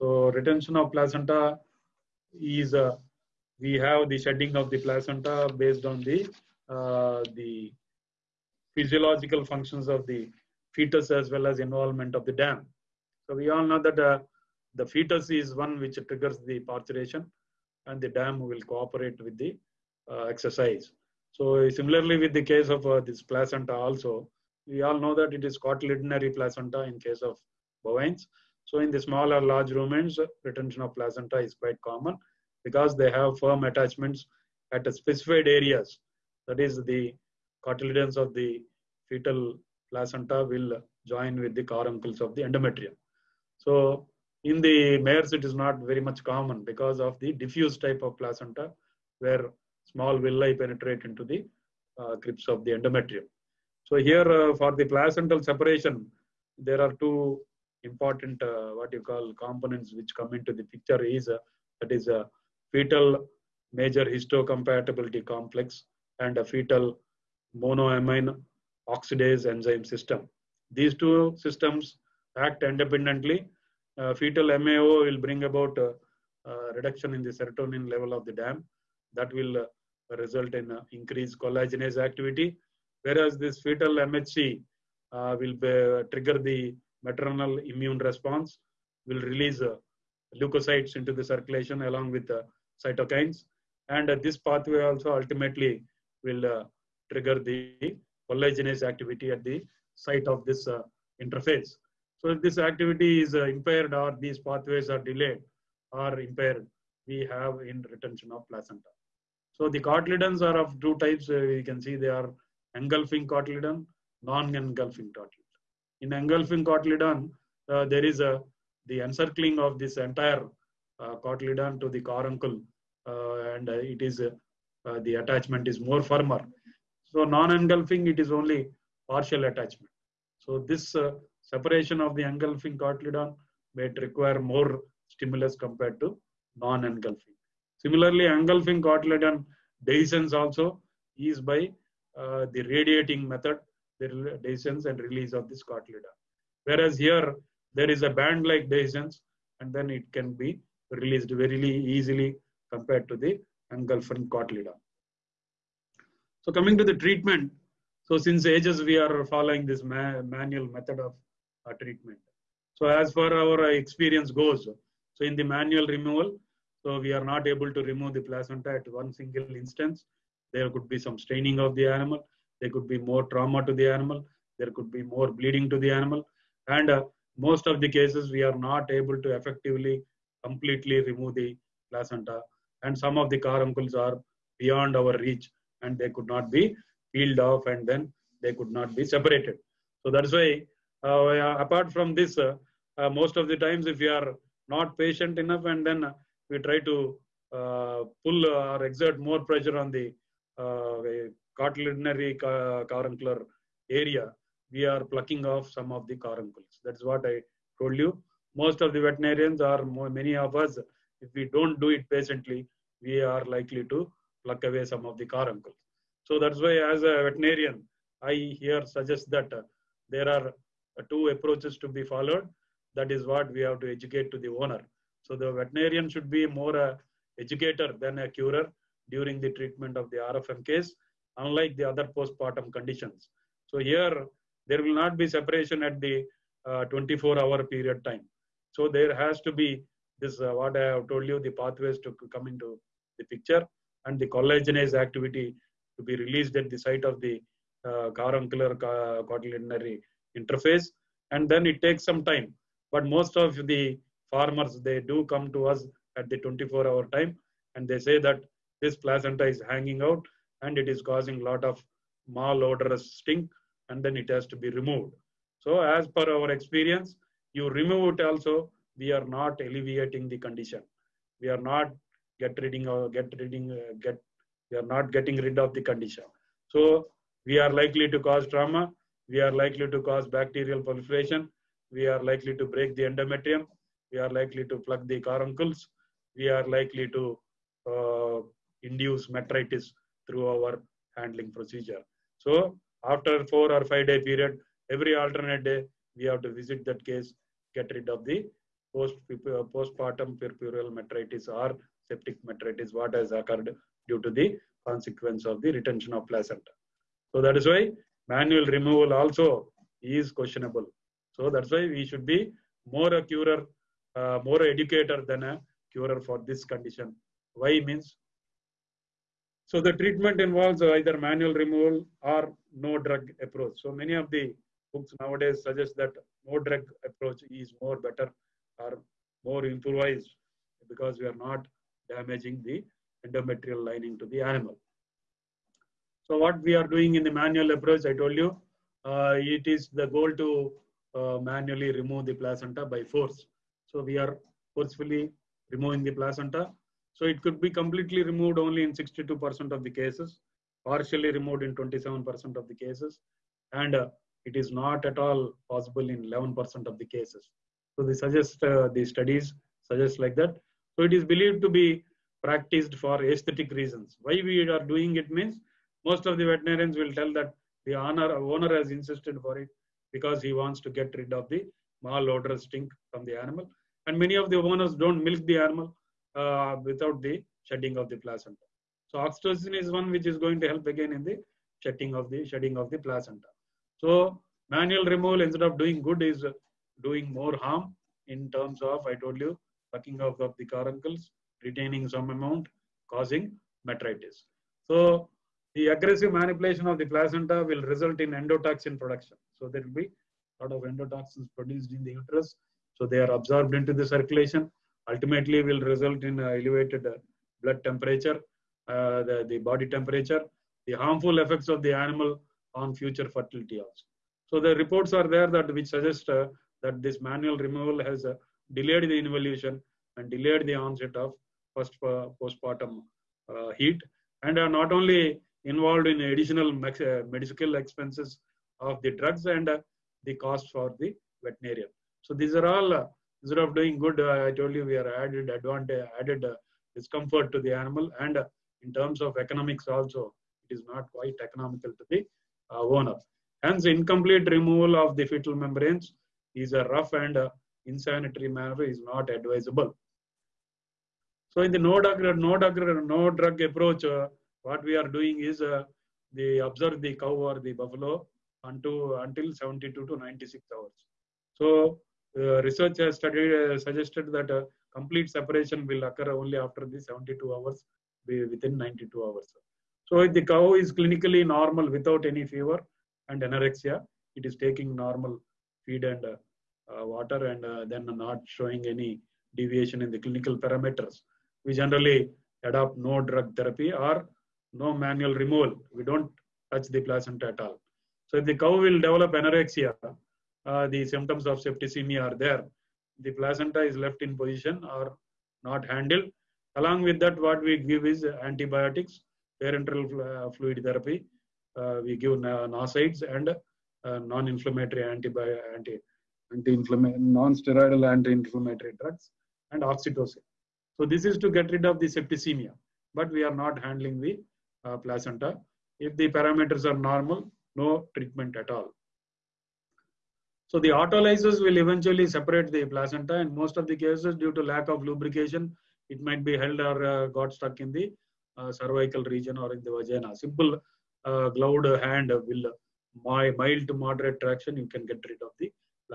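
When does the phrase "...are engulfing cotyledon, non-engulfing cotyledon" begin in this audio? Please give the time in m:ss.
1:52.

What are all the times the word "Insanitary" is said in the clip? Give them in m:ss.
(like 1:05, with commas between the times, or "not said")
7:27.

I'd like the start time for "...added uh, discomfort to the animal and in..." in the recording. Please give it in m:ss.
7:16.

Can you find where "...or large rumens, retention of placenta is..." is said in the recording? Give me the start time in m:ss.
0:29.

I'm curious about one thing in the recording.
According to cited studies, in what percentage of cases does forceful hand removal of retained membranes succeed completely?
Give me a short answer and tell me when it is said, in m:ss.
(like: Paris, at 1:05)
62%, at 5:48.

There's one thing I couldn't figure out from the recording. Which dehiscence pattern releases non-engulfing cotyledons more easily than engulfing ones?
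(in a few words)
band-like.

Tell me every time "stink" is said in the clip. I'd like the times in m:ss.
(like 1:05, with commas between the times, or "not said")
4:23, 6:12.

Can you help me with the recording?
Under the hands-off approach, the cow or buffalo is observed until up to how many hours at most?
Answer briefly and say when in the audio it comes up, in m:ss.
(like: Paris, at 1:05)
96, at 7:40.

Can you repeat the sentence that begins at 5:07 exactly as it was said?
So that is why manual removal also is questionable.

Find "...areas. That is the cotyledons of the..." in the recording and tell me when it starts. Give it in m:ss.
0:35.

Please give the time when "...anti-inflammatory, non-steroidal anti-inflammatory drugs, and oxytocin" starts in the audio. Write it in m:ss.
8:26.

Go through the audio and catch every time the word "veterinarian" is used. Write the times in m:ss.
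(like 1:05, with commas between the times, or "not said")
3:29, 3:37, 3:45, 6:06, 7:11.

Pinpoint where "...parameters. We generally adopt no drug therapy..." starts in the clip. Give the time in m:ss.
8:00.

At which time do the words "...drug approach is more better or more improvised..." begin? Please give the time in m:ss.
5:26.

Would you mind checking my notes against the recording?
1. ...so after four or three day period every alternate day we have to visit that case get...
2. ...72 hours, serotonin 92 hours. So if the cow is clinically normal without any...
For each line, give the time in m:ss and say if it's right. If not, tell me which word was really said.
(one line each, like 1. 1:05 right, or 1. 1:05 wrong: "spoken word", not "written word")
1. 4:52 wrong: "five", not "three"
2. 7:46 wrong: "within", not "serotonin".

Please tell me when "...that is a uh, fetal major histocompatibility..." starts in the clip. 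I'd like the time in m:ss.
1:01.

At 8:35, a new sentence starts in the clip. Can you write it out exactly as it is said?
If the parameters are normal, no treatment at all.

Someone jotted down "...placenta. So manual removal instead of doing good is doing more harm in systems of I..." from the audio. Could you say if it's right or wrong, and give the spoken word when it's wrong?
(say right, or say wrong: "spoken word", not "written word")
wrong: "terms", not "systems".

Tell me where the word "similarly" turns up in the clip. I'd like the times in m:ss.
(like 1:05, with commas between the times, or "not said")
0:21, 2:17.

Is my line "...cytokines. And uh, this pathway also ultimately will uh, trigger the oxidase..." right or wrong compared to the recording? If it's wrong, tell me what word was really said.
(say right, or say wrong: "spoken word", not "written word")
wrong: "collagenase", not "oxidase".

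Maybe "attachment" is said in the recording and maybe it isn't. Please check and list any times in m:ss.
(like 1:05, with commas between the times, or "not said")
0:33, 2:05, 2:09.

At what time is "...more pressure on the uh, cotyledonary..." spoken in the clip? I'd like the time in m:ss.
3:19.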